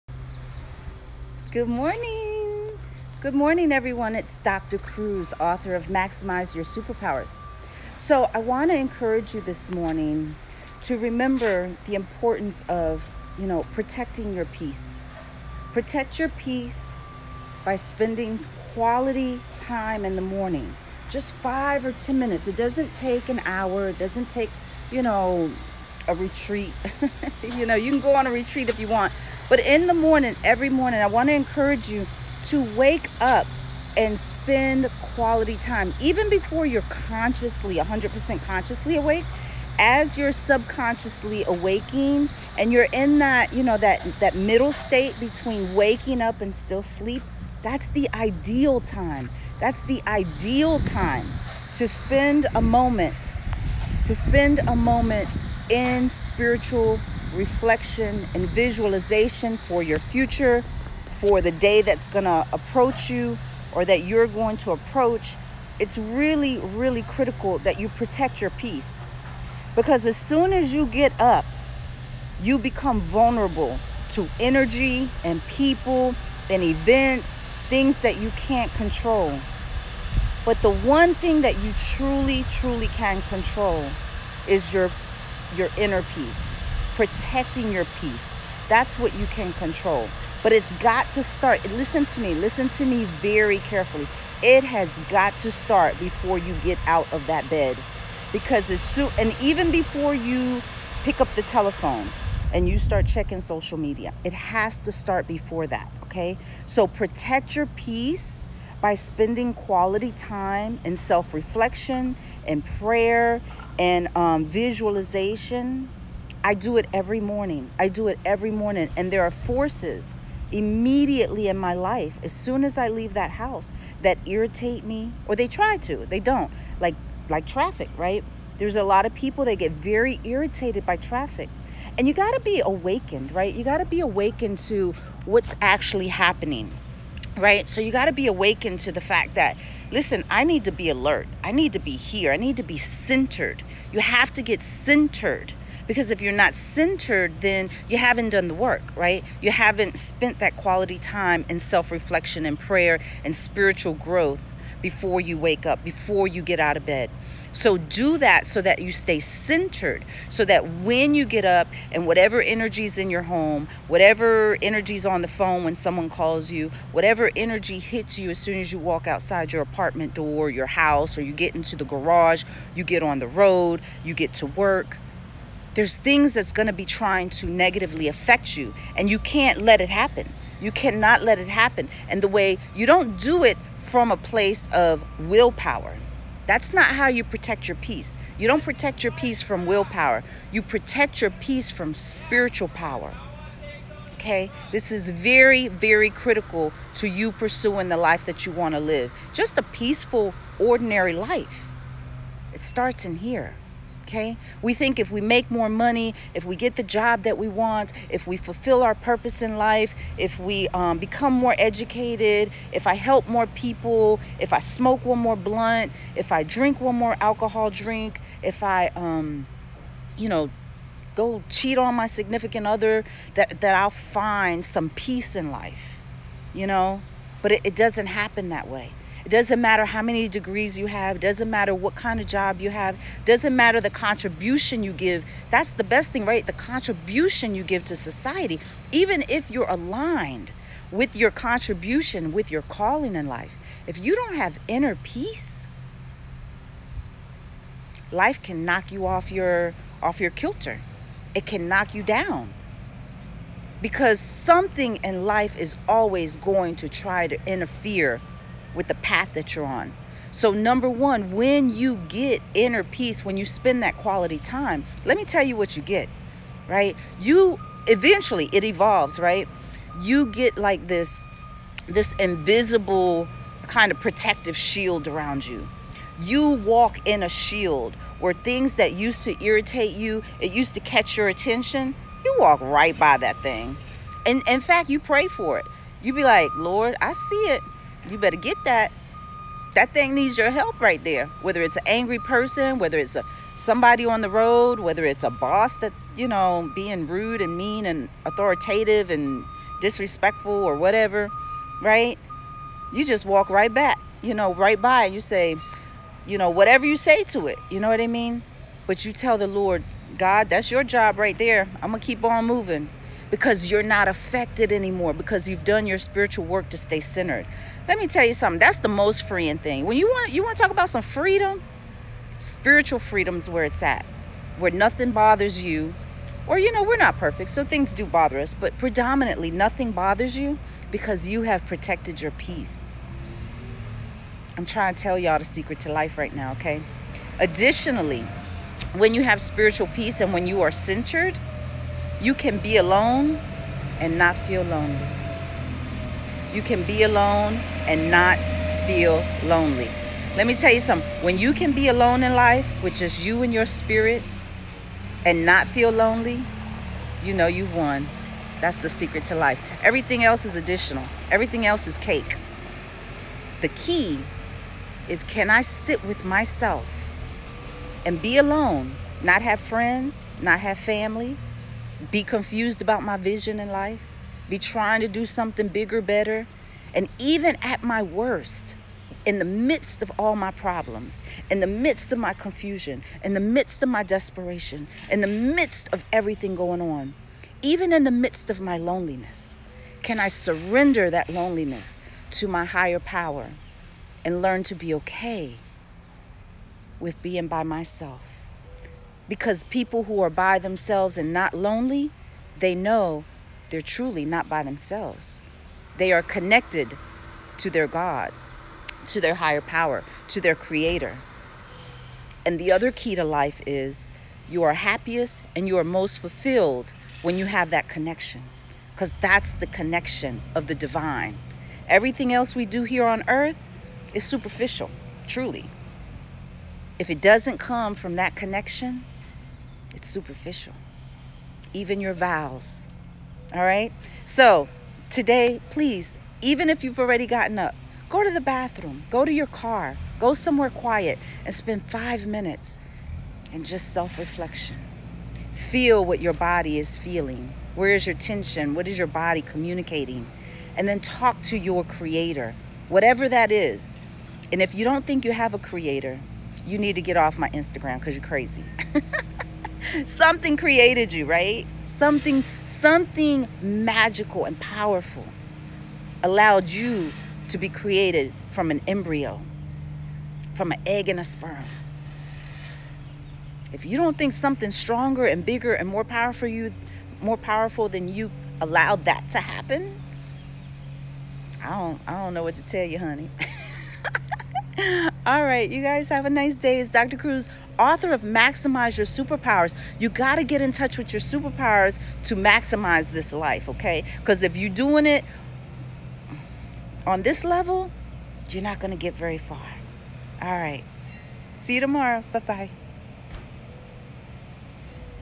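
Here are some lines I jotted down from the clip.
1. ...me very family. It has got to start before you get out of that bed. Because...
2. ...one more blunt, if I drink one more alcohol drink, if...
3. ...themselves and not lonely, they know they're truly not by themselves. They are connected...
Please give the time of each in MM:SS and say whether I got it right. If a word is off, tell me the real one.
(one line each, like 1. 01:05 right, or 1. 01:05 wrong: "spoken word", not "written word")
1. 01:32 wrong: "carefully", not "family"
2. 03:35 right
3. 06:40 right.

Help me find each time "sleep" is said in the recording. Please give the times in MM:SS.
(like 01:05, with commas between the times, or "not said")
00:46.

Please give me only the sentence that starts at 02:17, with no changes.
So you gotta be awakened to the fact that listen, I need to be alert.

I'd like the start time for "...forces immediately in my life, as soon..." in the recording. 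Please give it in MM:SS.
01:59.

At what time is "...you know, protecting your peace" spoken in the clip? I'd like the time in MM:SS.
00:13.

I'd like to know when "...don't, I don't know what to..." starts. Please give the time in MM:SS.
08:01.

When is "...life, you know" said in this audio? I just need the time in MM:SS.
03:45.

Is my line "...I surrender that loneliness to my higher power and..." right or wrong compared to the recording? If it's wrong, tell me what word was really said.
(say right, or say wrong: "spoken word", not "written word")
right.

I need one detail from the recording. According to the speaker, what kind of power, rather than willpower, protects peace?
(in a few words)
Spiritual power.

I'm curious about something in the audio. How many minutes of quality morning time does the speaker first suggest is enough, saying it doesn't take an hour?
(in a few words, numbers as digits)
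5 or 10.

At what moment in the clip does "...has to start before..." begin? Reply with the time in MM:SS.
01:44.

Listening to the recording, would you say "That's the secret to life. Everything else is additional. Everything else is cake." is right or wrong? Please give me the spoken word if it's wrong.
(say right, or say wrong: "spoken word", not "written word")
right.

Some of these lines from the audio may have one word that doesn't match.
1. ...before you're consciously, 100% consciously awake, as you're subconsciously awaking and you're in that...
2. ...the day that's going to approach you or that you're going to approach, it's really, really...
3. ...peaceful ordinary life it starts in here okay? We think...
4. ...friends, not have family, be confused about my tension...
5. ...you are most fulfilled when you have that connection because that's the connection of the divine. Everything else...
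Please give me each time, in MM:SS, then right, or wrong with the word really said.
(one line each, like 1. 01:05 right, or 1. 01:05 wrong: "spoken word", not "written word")
1. 00:36 right
2. 01:01 right
3. 03:19 right
4. 06:09 wrong: "vision", not "tension"
5. 06:55 right.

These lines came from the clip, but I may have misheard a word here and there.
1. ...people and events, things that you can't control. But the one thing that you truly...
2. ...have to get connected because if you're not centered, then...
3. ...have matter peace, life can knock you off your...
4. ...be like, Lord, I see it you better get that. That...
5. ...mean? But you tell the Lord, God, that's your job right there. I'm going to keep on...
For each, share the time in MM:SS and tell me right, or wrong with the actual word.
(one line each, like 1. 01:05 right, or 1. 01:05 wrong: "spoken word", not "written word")
1. 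01:15 right
2. 02:23 wrong: "centered", not "connected"
3. 04:04 wrong: "inner", not "matter"
4. 04:46 right
5. 05:08 right.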